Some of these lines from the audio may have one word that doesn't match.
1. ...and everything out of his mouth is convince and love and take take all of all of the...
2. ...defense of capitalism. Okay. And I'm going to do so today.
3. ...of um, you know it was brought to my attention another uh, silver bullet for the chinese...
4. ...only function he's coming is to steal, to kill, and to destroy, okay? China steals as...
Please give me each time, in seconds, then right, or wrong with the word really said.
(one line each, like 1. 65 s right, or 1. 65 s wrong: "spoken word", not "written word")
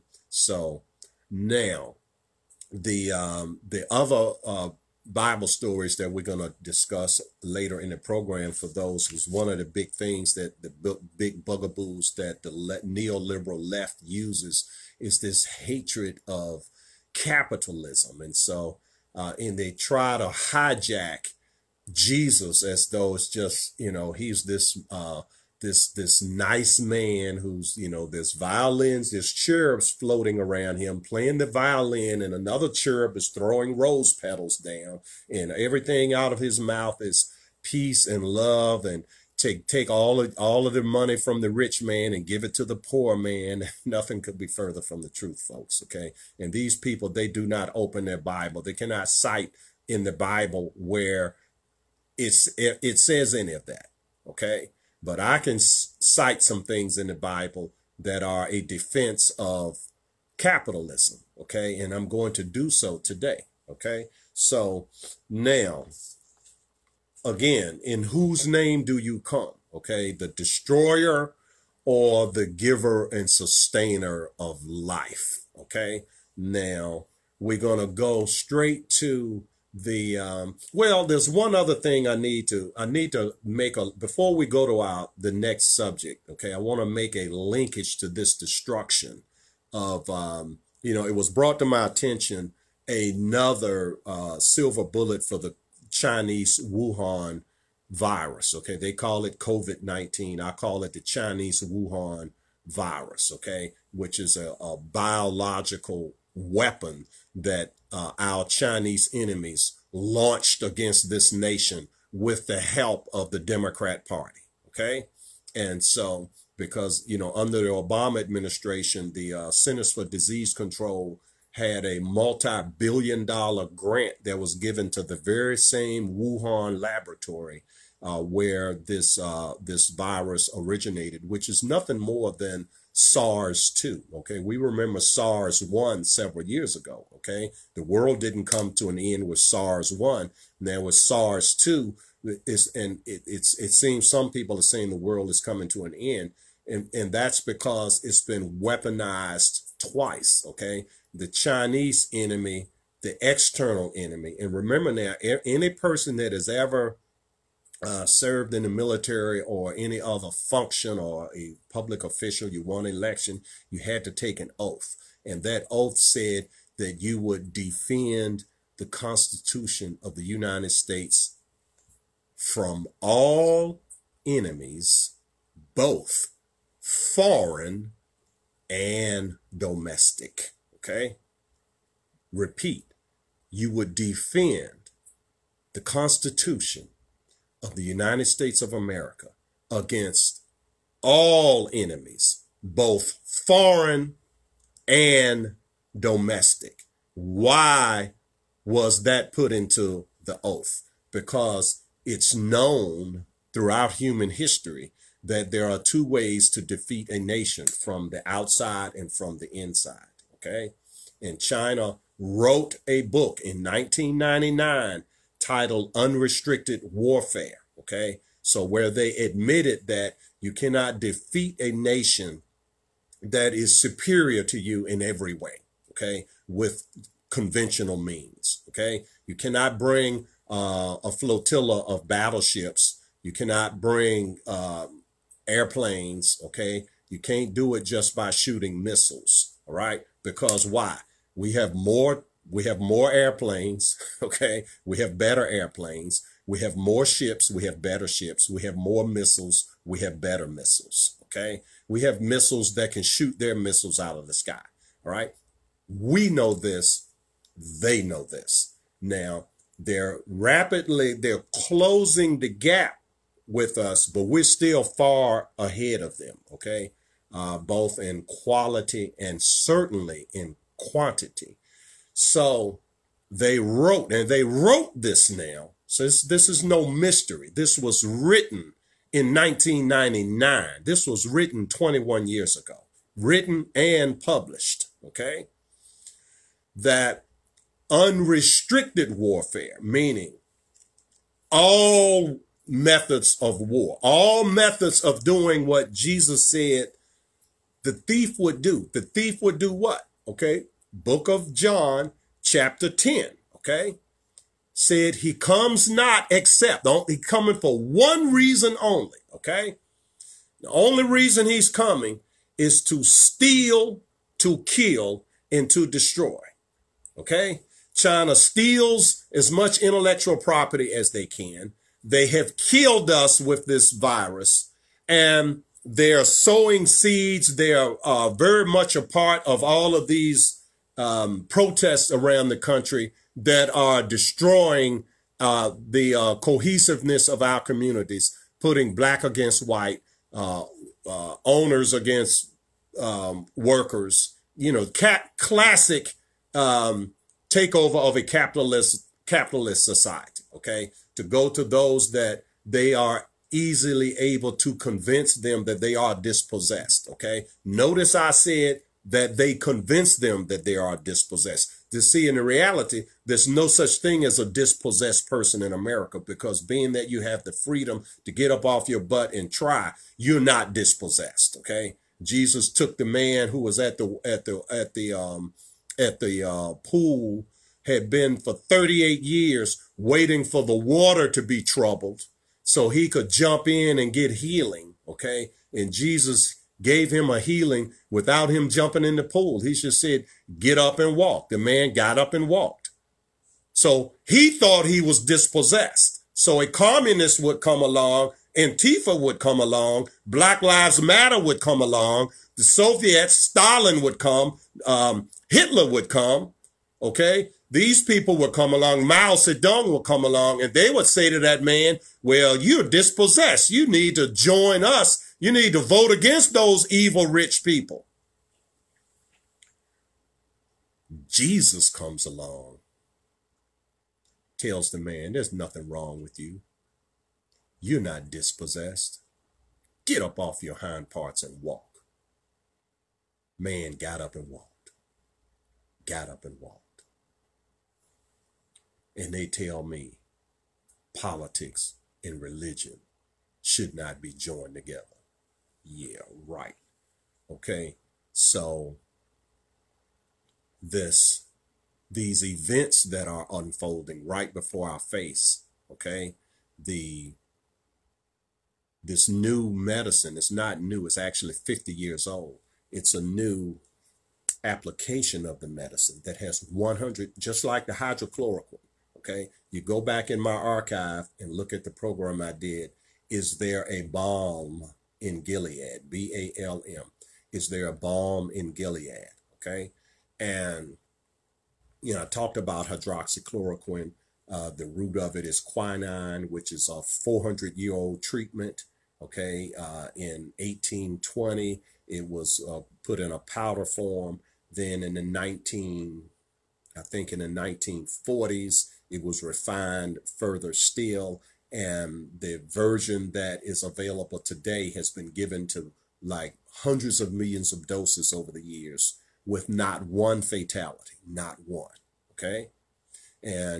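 1. 35 s wrong: "peace", not "convince"
2. 58 s right
3. 89 s right
4. 310 s wrong: "reason", not "function".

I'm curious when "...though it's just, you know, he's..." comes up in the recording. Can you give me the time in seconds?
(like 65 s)
22 s.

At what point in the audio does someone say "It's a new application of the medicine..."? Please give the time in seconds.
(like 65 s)
462 s.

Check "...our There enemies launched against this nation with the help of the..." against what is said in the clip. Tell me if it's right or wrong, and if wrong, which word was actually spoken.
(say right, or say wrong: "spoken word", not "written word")
wrong: "Chinese", not "There".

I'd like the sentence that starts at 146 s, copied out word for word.
And, and that's because it's been weaponized twice.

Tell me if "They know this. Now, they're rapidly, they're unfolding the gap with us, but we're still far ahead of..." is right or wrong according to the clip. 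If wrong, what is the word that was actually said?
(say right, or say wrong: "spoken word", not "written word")
wrong: "closing", not "unfolding".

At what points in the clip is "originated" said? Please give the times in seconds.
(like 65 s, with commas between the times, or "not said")
130 s.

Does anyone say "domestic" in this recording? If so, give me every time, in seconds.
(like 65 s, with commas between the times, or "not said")
179 s, 195 s.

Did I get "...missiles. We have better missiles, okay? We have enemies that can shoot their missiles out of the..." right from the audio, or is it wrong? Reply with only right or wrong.
wrong.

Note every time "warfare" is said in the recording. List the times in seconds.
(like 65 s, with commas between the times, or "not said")
216 s, 289 s.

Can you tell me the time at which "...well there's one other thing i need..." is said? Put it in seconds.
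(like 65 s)
80 s.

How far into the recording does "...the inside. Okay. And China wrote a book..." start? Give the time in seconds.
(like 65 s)
209 s.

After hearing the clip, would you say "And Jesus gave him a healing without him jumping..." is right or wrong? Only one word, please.
right.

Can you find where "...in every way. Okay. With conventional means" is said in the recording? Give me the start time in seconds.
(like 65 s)
224 s.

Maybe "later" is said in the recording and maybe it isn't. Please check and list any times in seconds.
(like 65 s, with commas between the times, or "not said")
7 s.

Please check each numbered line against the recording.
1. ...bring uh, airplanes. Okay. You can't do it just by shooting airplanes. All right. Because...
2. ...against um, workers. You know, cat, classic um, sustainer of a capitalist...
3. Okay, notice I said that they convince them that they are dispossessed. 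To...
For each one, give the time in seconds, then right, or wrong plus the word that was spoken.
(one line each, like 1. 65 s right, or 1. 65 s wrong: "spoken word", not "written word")
1. 233 s wrong: "missiles", not "airplanes"
2. 341 s wrong: "takeover", not "sustainer"
3. 357 s right.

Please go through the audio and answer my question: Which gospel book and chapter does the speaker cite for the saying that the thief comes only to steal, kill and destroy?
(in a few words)
John, chapter 10.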